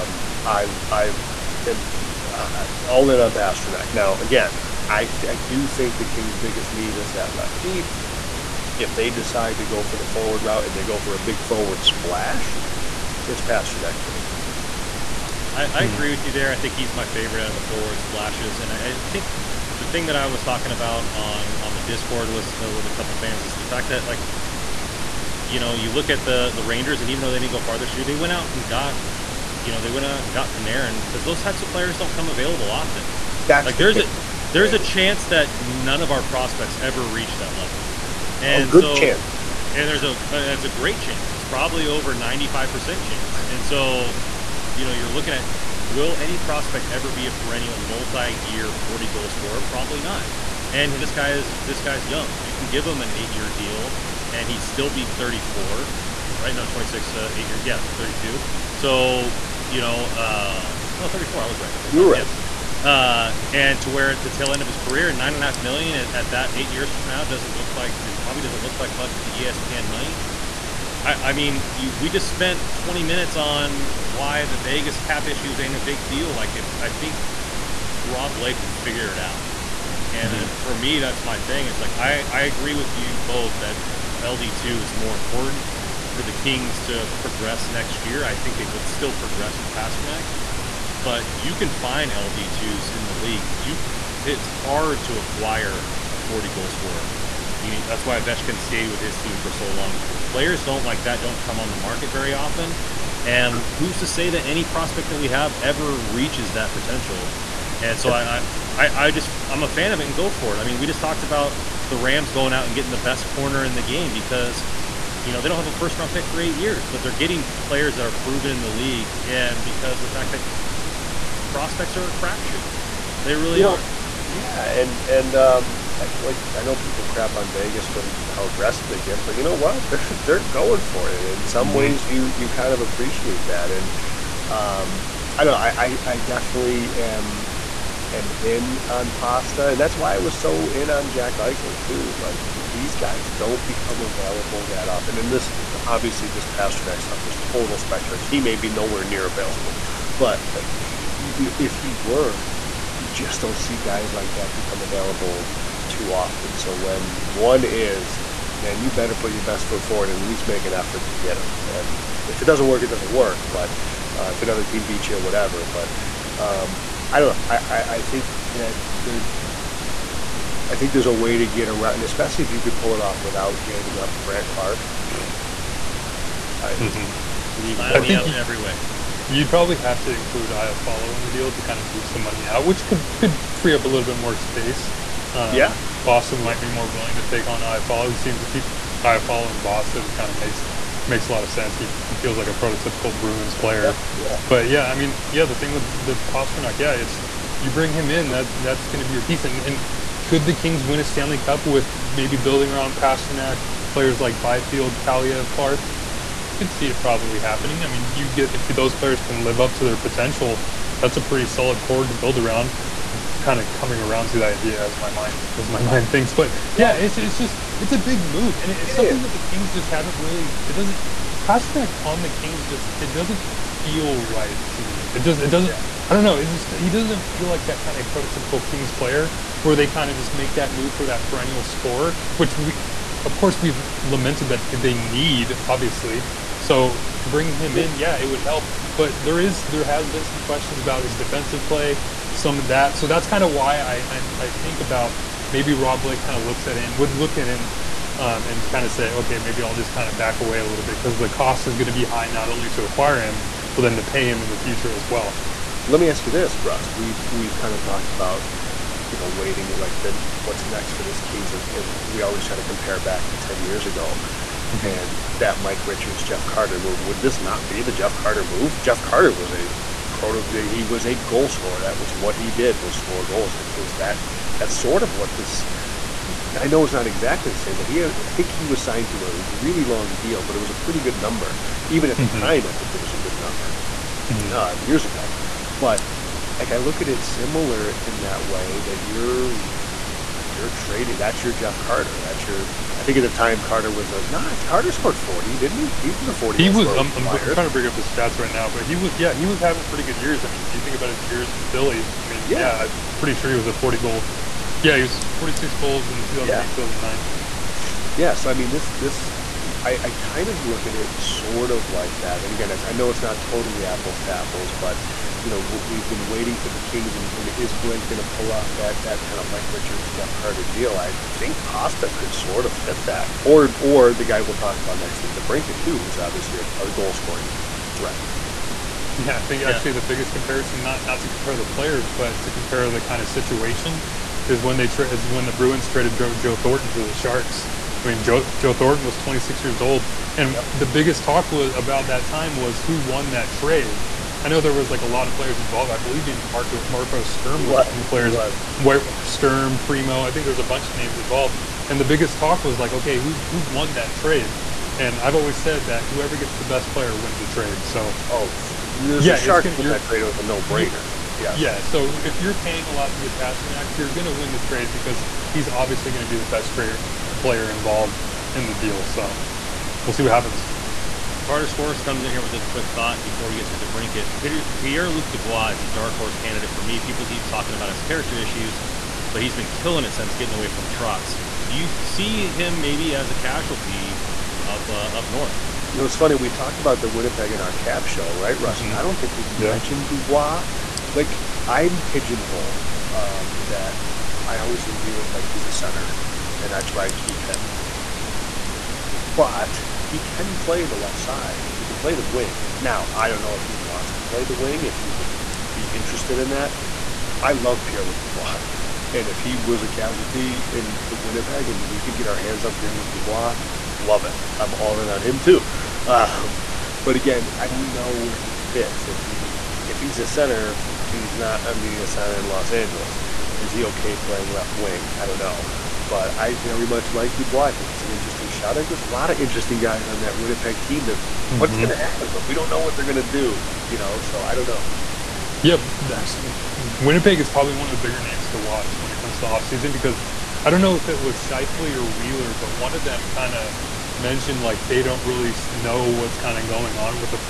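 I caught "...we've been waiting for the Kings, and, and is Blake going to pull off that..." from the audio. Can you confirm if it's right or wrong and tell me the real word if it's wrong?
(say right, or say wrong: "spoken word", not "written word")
right.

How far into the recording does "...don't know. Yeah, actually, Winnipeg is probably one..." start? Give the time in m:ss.
7:14.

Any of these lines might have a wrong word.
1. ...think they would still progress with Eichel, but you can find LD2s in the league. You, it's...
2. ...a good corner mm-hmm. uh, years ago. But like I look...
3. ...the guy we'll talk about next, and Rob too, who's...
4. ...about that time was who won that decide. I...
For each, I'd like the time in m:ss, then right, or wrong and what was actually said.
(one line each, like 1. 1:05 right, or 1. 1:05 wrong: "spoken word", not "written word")
1. 1:28 wrong: "Pastrnak", not "Eichel"
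2. 4:43 wrong: "number", not "corner"
3. 5:24 wrong: "DeBrincat", not "Rob"
4. 5:41 wrong: "trade", not "decide".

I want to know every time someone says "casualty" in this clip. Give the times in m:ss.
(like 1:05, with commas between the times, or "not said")
6:23, 6:49.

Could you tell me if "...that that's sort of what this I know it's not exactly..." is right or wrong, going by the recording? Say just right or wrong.
right.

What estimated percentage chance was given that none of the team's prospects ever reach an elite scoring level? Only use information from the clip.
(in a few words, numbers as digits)
95%.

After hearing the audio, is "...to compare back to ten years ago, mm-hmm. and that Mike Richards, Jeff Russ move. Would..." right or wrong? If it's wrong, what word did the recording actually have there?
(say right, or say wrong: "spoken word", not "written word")
wrong: "Carter", not "Russ".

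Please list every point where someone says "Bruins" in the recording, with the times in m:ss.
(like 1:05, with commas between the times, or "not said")
3:13, 5:35.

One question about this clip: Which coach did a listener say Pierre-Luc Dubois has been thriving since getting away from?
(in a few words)
Trotz.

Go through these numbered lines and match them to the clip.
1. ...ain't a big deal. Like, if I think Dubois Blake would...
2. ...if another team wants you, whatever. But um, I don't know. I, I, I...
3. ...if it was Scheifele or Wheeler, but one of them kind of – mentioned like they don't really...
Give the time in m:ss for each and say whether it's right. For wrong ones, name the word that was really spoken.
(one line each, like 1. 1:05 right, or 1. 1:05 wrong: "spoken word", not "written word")
1. 1:15 wrong: "Rob", not "Dubois"
2. 2:44 wrong: "beats", not "wants"
3. 7:20 right.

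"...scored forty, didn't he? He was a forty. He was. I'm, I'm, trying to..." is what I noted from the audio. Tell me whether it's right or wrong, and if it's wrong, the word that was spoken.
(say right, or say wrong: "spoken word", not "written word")
right.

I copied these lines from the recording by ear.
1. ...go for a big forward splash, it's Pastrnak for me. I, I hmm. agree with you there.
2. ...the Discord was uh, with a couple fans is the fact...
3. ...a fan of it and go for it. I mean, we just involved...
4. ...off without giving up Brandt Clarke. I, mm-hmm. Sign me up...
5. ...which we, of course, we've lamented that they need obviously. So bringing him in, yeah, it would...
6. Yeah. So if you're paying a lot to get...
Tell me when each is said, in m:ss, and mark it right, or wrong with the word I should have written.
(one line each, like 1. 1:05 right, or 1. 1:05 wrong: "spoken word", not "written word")
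1. 0:10 right
2. 0:21 right
3. 1:49 wrong: "talked", not "involved"
4. 2:52 right
5. 3:52 right
6. 6:01 right.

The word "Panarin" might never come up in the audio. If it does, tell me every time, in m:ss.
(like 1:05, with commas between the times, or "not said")
0:30.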